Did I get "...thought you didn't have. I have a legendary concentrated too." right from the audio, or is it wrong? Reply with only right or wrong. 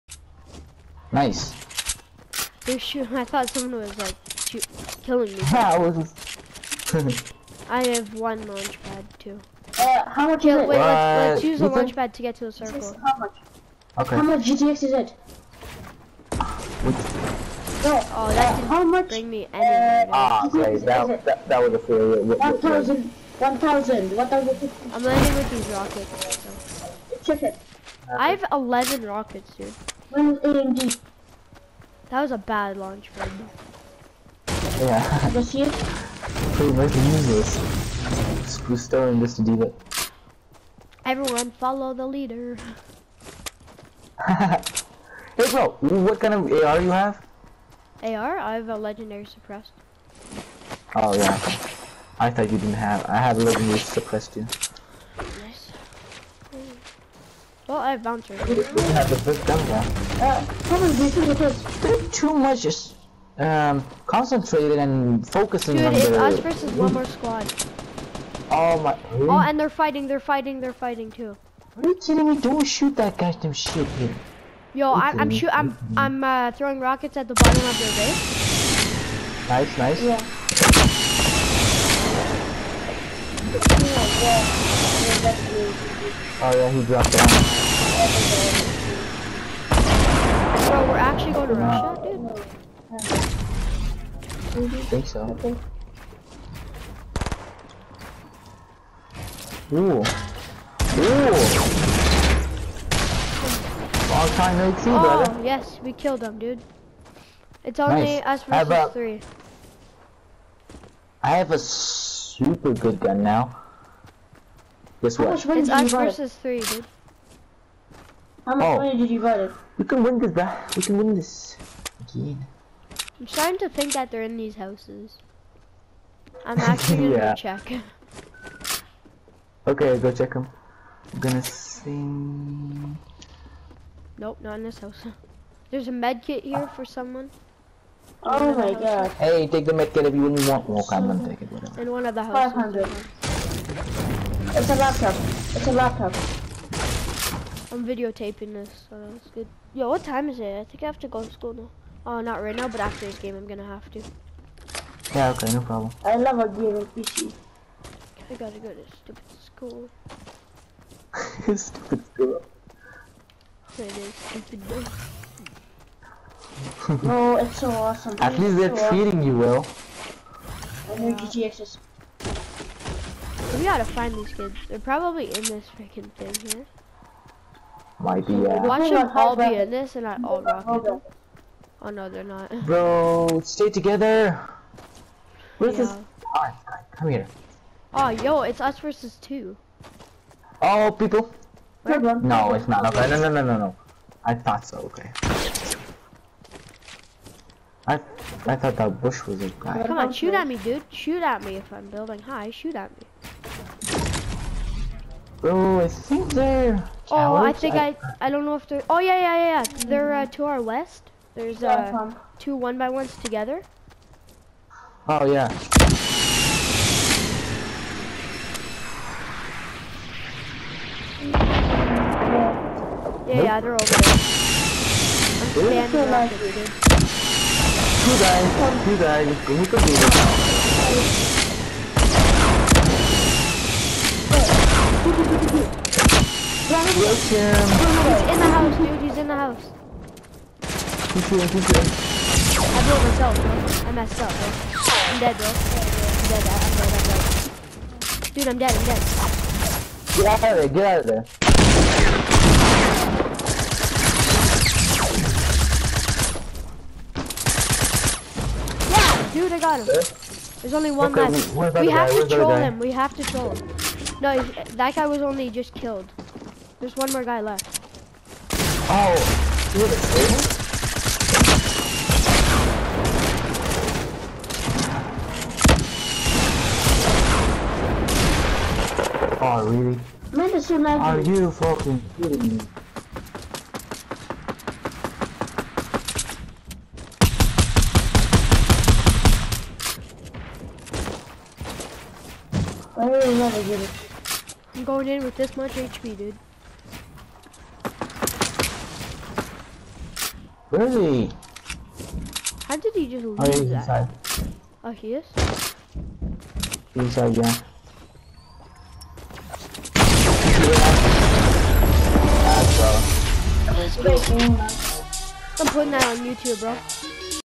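wrong.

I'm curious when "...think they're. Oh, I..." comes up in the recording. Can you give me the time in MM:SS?
03:25.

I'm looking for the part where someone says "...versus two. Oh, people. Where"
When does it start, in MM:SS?
03:08.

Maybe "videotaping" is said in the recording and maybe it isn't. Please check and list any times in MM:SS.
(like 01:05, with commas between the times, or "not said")
02:27.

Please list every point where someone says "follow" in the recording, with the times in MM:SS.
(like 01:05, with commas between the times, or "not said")
00:41.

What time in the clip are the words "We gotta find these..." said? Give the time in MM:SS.
02:53.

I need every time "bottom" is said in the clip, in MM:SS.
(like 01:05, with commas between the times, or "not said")
01:17.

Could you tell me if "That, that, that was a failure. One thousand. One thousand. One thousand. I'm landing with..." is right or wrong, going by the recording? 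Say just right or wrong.
right.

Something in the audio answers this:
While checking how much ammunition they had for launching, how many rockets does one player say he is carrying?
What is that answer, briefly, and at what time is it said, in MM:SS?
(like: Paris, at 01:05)
11, at 00:28.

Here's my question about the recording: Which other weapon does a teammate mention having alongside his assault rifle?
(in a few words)
bouncer.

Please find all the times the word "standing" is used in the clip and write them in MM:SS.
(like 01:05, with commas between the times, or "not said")
03:45.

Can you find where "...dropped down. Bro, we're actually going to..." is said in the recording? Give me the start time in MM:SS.
01:26.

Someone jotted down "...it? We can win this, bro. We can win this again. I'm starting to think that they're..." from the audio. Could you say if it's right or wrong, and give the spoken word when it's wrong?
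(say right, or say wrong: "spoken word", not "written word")
right.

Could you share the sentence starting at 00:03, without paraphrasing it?
I thought someone was like shoot, killing me.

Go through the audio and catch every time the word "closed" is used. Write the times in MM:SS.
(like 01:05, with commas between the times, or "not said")
not said.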